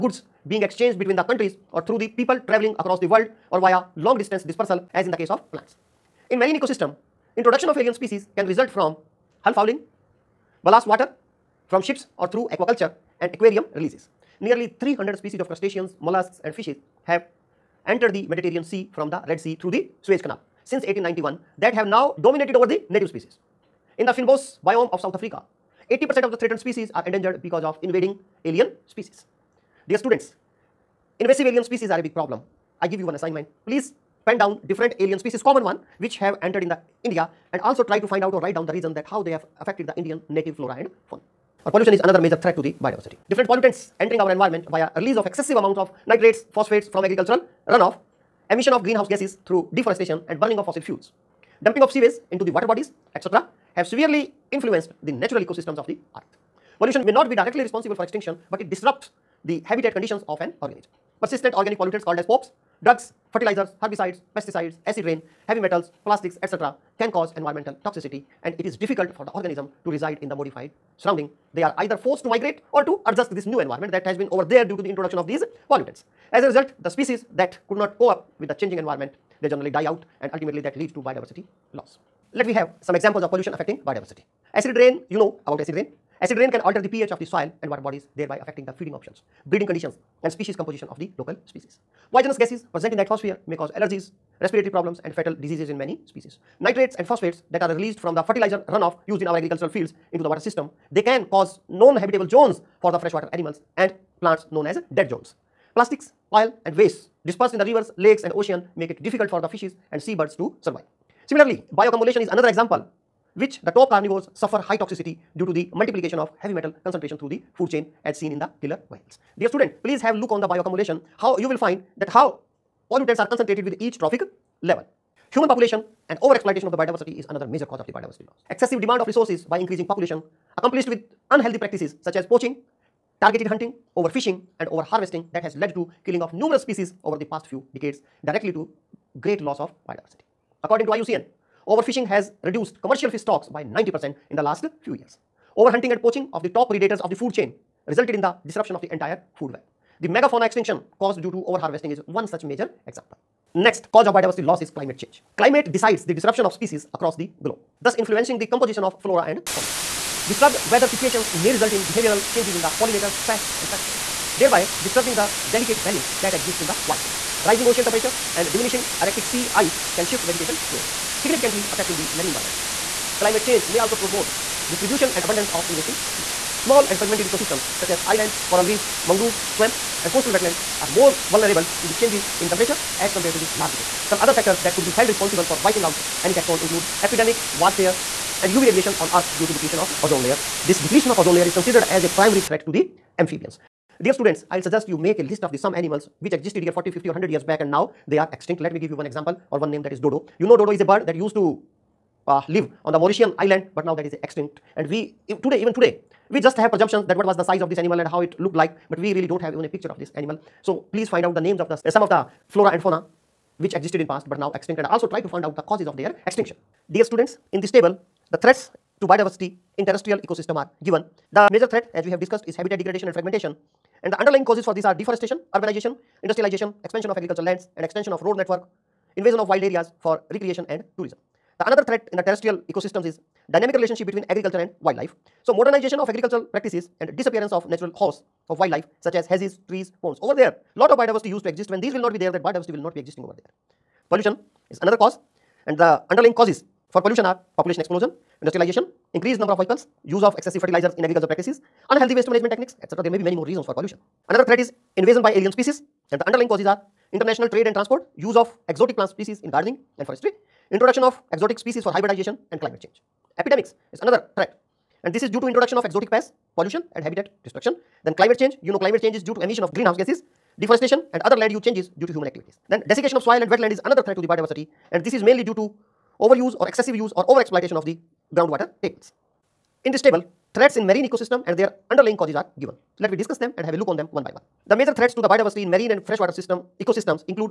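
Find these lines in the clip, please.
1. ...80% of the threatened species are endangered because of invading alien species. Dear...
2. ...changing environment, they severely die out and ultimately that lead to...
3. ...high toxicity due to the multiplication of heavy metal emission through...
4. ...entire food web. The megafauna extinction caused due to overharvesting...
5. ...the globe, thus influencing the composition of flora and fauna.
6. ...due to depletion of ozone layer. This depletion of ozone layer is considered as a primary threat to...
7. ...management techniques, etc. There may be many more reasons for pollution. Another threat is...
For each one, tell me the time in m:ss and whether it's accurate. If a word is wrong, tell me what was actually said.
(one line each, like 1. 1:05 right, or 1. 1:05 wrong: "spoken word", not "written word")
1. 0:25 right
2. 1:18 wrong: "generally", not "severely"
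3. 1:54 wrong: "concentration", not "emission"
4. 2:28 right
5. 2:37 right
6. 3:09 right
7. 4:12 right.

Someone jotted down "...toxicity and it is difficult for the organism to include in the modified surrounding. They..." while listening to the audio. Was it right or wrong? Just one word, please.
wrong.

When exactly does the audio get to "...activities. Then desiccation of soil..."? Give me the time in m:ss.
4:32.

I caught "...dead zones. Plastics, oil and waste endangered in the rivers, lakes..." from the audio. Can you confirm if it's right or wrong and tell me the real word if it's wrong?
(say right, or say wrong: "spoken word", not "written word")
wrong: "dispersed", not "endangered".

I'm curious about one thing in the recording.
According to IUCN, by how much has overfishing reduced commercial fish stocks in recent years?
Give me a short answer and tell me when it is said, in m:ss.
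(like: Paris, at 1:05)
90 percent, at 2:23.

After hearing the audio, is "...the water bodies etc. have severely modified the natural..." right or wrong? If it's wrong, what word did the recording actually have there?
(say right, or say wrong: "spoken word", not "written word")
wrong: "influenced", not "modified".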